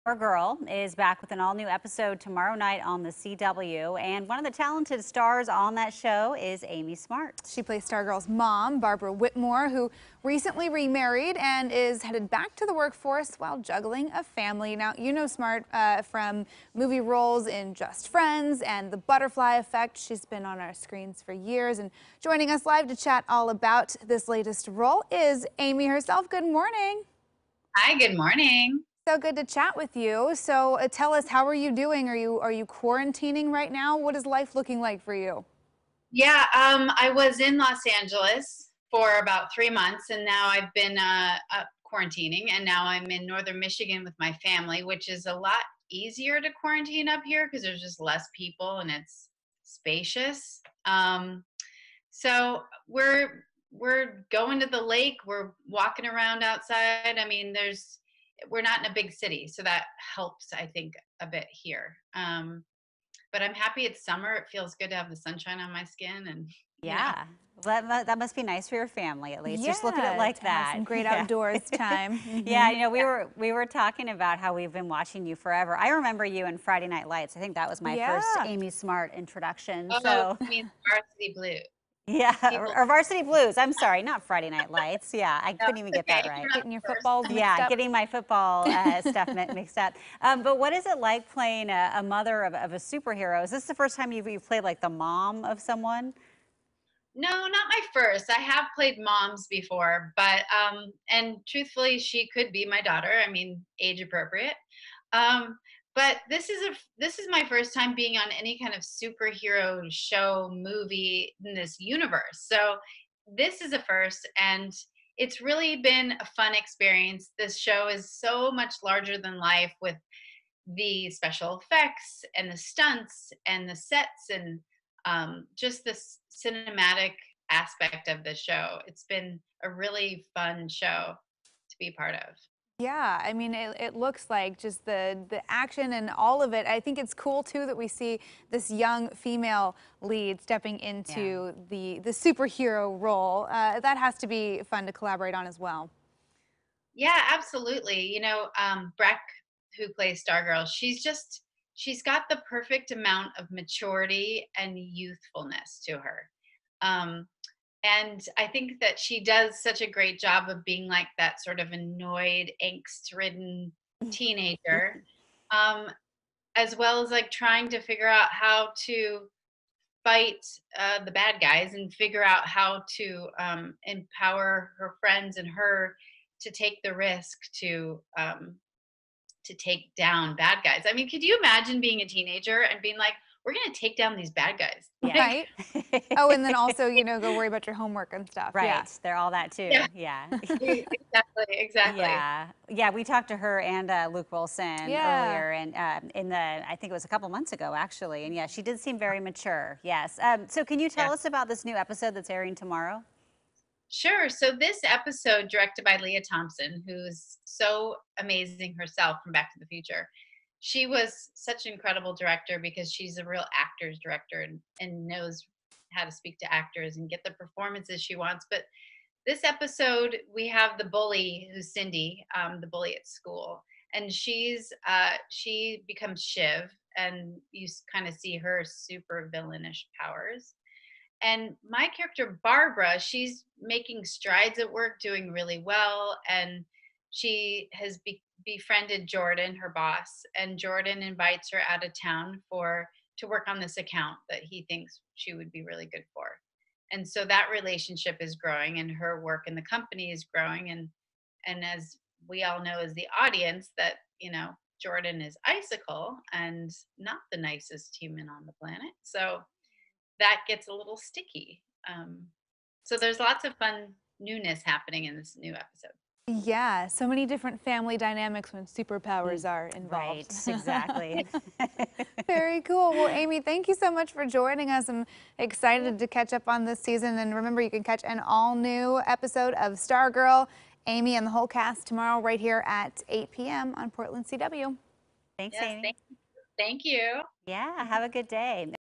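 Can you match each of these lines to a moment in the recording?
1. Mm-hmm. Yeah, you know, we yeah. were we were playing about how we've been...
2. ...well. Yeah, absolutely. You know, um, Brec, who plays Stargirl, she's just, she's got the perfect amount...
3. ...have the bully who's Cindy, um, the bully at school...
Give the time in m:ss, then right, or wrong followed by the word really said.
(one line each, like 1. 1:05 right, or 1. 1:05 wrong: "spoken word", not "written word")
1. 1:12 wrong: "talking", not "playing"
2. 2:25 right
3. 3:40 right.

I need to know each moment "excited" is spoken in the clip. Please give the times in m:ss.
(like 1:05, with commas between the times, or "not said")
4:35.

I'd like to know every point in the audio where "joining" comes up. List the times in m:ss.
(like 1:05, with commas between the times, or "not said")
0:22, 4:34.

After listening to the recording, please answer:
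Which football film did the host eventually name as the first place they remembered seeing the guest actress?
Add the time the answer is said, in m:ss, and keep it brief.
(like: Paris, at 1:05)
Varsity Blues, at 1:22.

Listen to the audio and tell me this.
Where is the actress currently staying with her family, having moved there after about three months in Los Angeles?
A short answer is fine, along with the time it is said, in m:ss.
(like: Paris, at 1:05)
Northern Michigan, at 0:43.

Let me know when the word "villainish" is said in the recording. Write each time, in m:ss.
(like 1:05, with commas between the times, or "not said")
3:49.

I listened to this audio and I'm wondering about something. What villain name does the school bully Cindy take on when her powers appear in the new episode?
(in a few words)
Shiv.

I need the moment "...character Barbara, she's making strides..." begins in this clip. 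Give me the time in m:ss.
3:51.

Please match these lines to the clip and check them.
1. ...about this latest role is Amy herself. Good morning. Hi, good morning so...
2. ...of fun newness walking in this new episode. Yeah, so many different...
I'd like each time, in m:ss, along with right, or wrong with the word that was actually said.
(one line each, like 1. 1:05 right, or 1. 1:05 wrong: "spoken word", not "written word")
1. 0:23 right
2. 4:23 wrong: "happening", not "walking".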